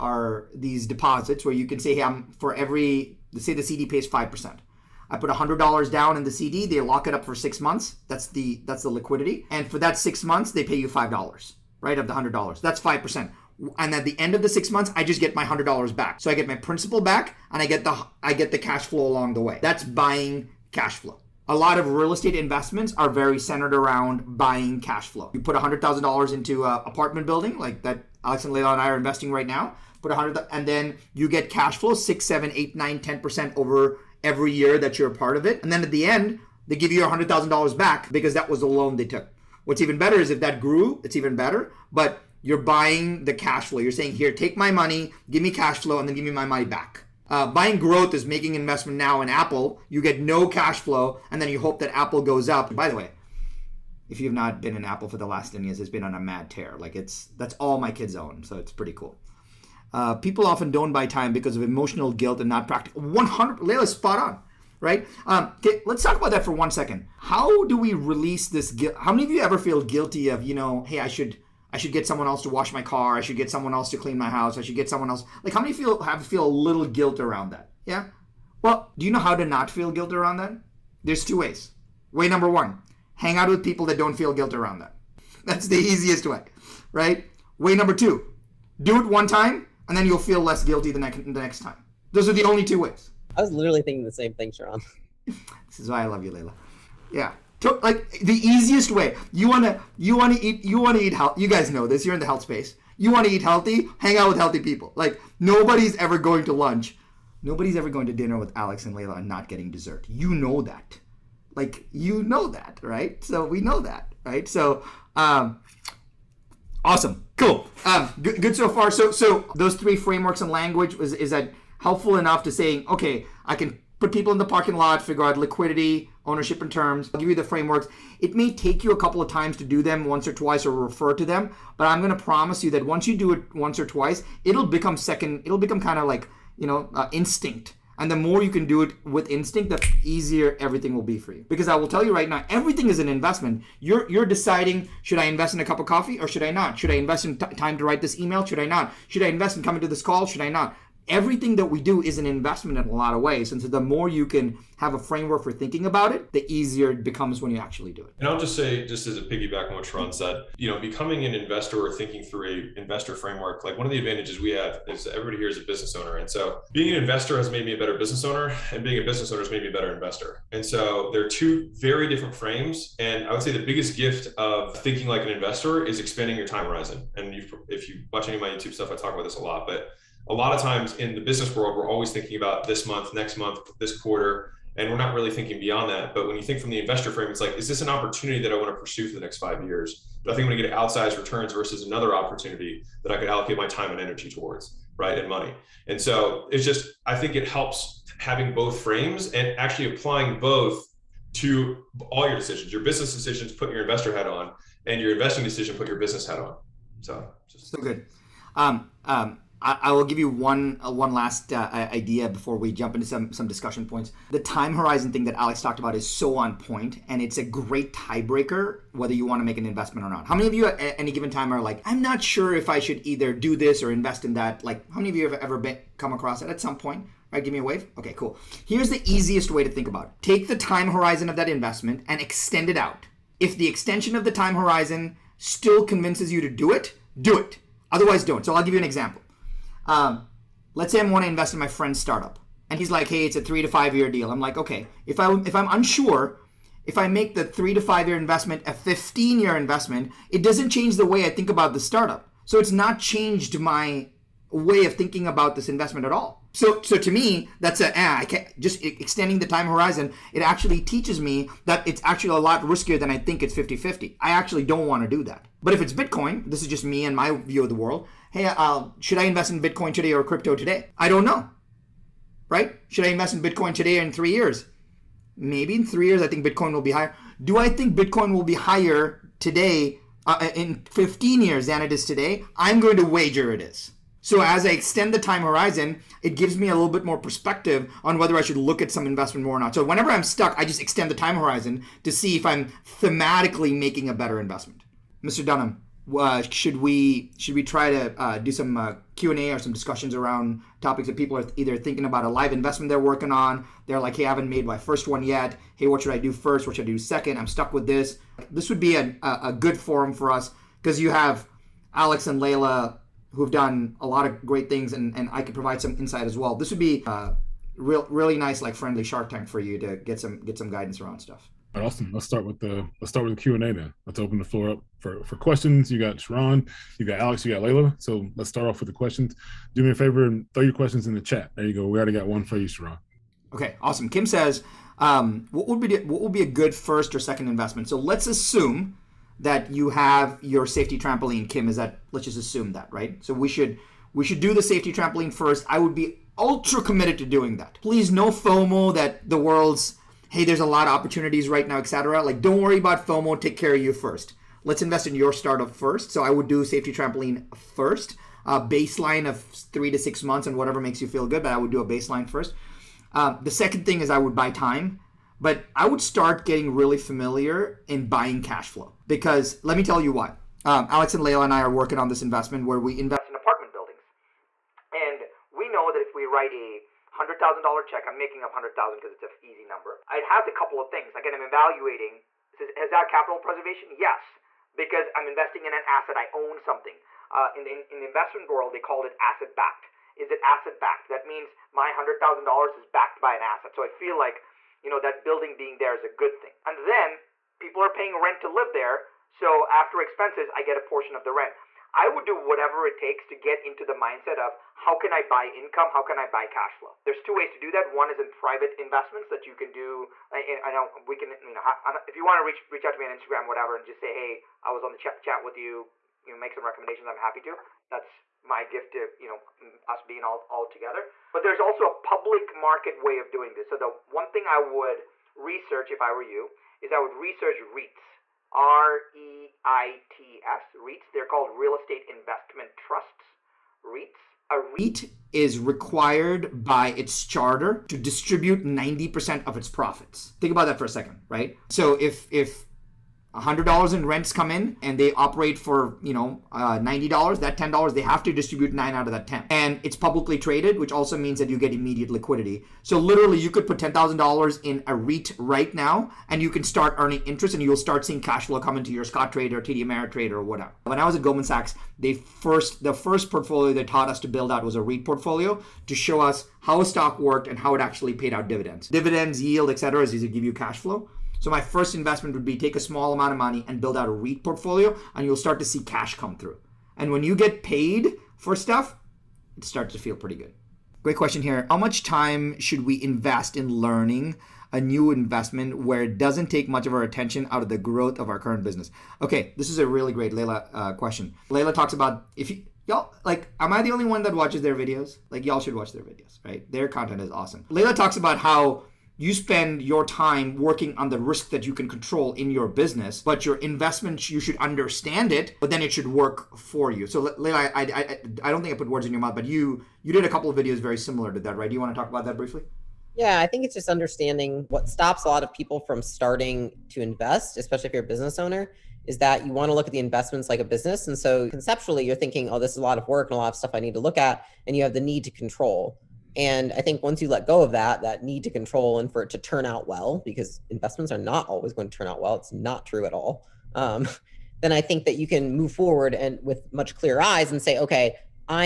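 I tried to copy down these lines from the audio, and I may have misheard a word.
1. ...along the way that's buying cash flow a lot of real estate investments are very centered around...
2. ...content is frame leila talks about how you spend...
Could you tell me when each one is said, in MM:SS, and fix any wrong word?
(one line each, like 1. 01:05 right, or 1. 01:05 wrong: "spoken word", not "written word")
1. 00:19 right
2. 08:16 wrong: "awesome", not "frame".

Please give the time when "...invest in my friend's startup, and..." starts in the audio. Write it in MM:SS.
04:01.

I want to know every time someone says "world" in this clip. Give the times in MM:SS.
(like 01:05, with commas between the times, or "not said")
03:01, 04:27, 05:49, 06:28.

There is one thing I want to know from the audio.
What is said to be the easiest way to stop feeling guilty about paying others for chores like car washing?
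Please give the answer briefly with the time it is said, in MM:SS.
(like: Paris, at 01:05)
Hang out with people that don't feel guilt, at 01:23.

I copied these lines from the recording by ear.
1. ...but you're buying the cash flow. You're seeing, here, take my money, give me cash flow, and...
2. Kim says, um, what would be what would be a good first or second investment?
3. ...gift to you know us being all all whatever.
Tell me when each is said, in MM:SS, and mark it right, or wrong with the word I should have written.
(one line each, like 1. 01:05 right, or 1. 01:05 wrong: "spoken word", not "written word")
1. 00:41 wrong: "saying", not "seeing"
2. 05:34 right
3. 06:58 wrong: "together", not "whatever".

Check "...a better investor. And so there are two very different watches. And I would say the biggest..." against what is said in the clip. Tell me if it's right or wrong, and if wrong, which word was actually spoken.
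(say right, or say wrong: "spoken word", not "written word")
wrong: "frames", not "watches".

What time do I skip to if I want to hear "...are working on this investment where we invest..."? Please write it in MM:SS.
06:11.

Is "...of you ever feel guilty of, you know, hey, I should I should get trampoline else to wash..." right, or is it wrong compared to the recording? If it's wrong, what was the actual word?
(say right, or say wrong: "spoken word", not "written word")
wrong: "someone", not "trampoline".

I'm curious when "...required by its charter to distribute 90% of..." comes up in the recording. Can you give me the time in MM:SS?
07:15.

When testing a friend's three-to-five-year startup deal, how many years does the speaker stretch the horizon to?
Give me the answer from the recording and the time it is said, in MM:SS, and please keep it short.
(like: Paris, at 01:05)
15, at 04:08.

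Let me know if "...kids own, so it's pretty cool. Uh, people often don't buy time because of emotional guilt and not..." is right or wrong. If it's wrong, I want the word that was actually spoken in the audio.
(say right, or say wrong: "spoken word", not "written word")
right.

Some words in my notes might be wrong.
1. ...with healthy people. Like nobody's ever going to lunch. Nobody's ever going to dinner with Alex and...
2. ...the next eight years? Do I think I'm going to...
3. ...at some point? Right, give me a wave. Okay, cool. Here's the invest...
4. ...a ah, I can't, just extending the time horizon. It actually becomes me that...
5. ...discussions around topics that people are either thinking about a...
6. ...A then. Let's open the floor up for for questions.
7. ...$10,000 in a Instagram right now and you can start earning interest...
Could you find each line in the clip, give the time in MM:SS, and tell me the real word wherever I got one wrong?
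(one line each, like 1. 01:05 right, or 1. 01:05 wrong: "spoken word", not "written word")
1. 01:44 right
2. 03:09 wrong: "five", not "eight"
3. 03:46 wrong: "easiest", not "invest"
4. 04:17 wrong: "teaches", not "becomes"
5. 04:59 right
6. 05:23 right
7. 07:33 wrong: "REIT", not "Instagram".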